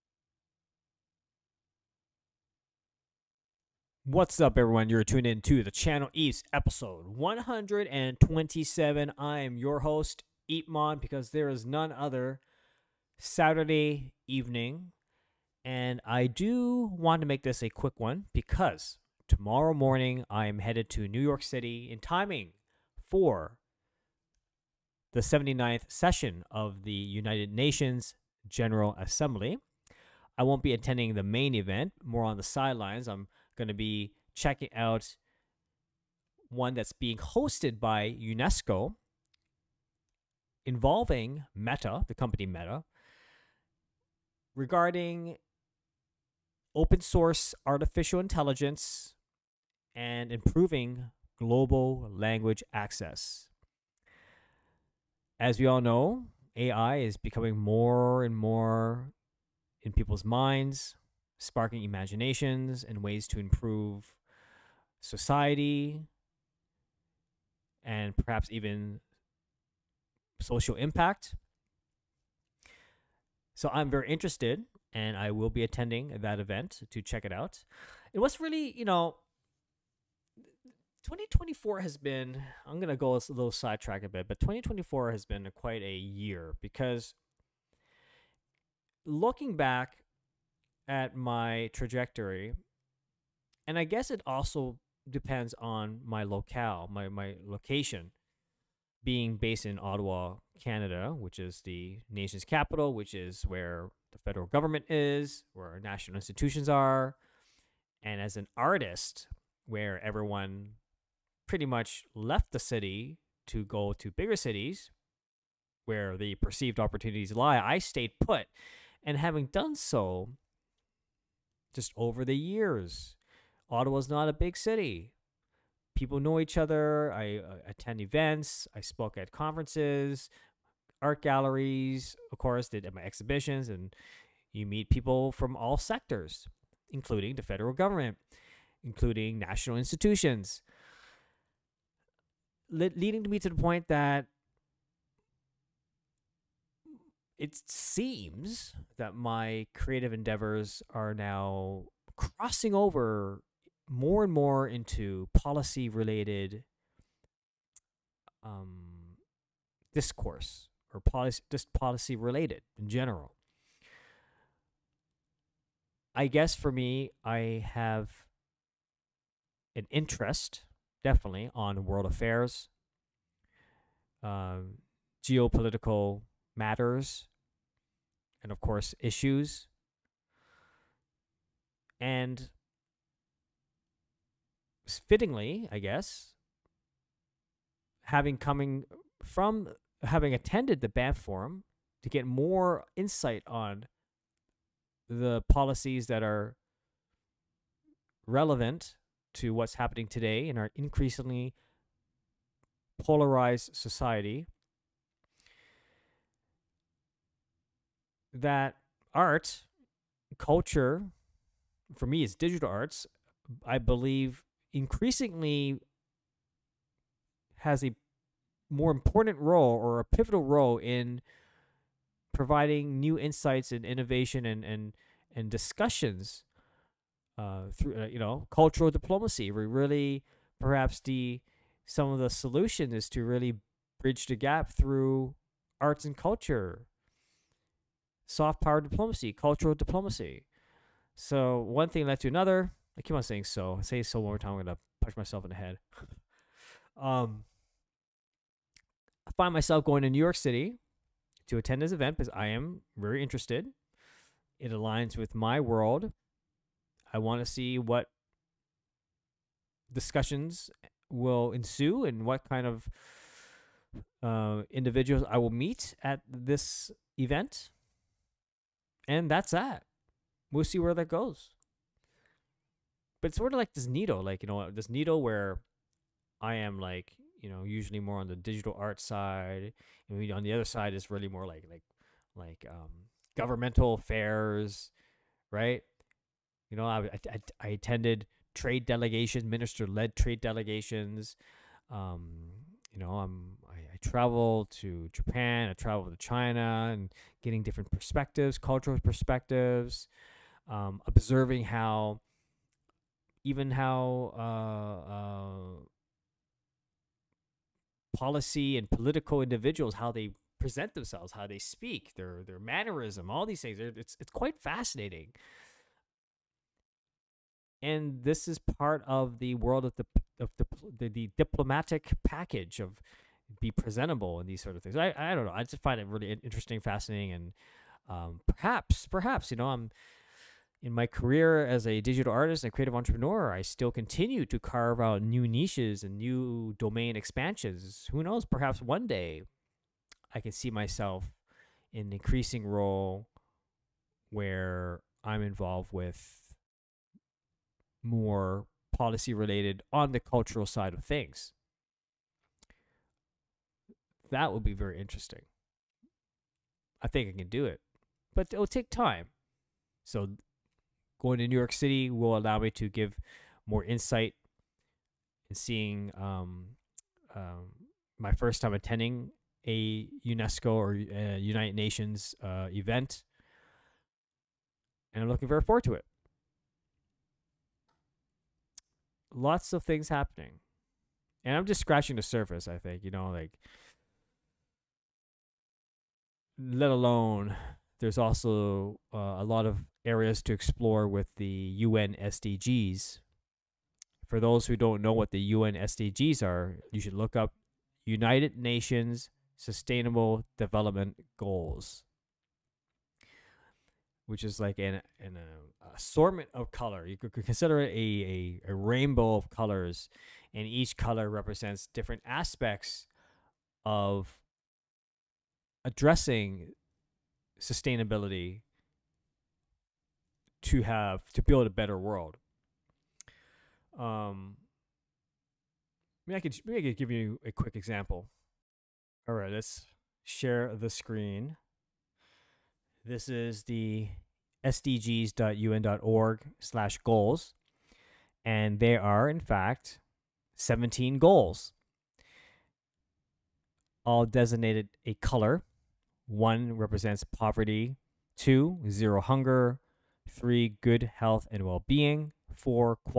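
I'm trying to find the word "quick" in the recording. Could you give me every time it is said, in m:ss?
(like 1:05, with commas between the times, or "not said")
0:17, 7:07.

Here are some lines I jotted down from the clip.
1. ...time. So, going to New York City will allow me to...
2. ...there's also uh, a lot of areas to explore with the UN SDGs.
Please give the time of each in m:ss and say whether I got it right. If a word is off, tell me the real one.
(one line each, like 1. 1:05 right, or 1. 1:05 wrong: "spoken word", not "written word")
1. 5:58 right
2. 6:27 right.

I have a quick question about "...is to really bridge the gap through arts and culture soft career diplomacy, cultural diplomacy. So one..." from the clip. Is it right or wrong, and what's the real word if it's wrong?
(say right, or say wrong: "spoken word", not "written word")
wrong: "power", not "career".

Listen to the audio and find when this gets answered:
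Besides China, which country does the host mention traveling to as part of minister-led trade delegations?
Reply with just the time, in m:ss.
4:55.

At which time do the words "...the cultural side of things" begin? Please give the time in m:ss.
5:50.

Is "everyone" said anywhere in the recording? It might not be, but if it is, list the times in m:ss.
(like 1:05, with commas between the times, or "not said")
0:04, 1:50.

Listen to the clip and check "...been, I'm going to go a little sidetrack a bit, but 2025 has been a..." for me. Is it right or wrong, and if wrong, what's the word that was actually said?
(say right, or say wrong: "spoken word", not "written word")
wrong: "2024", not "2025".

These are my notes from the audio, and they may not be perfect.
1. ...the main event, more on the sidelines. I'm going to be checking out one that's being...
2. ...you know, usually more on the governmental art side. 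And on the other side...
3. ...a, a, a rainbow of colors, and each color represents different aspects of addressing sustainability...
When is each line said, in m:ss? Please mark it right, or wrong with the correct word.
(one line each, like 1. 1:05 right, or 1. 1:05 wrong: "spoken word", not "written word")
1. 0:31 right
2. 4:37 wrong: "digital", not "governmental"
3. 6:47 right.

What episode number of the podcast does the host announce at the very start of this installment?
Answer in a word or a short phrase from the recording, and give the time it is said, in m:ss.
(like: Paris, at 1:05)
127, at 0:06.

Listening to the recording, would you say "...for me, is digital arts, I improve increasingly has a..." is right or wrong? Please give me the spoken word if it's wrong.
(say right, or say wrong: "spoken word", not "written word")
wrong: "believe", not "improve".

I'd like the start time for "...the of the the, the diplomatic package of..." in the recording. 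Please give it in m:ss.
5:19.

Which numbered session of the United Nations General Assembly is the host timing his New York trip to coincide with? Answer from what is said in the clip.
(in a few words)
79th.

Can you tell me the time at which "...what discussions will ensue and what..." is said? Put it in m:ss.
4:17.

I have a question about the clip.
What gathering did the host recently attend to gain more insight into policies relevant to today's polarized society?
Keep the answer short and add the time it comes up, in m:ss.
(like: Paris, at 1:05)
Banff Forum, at 3:10.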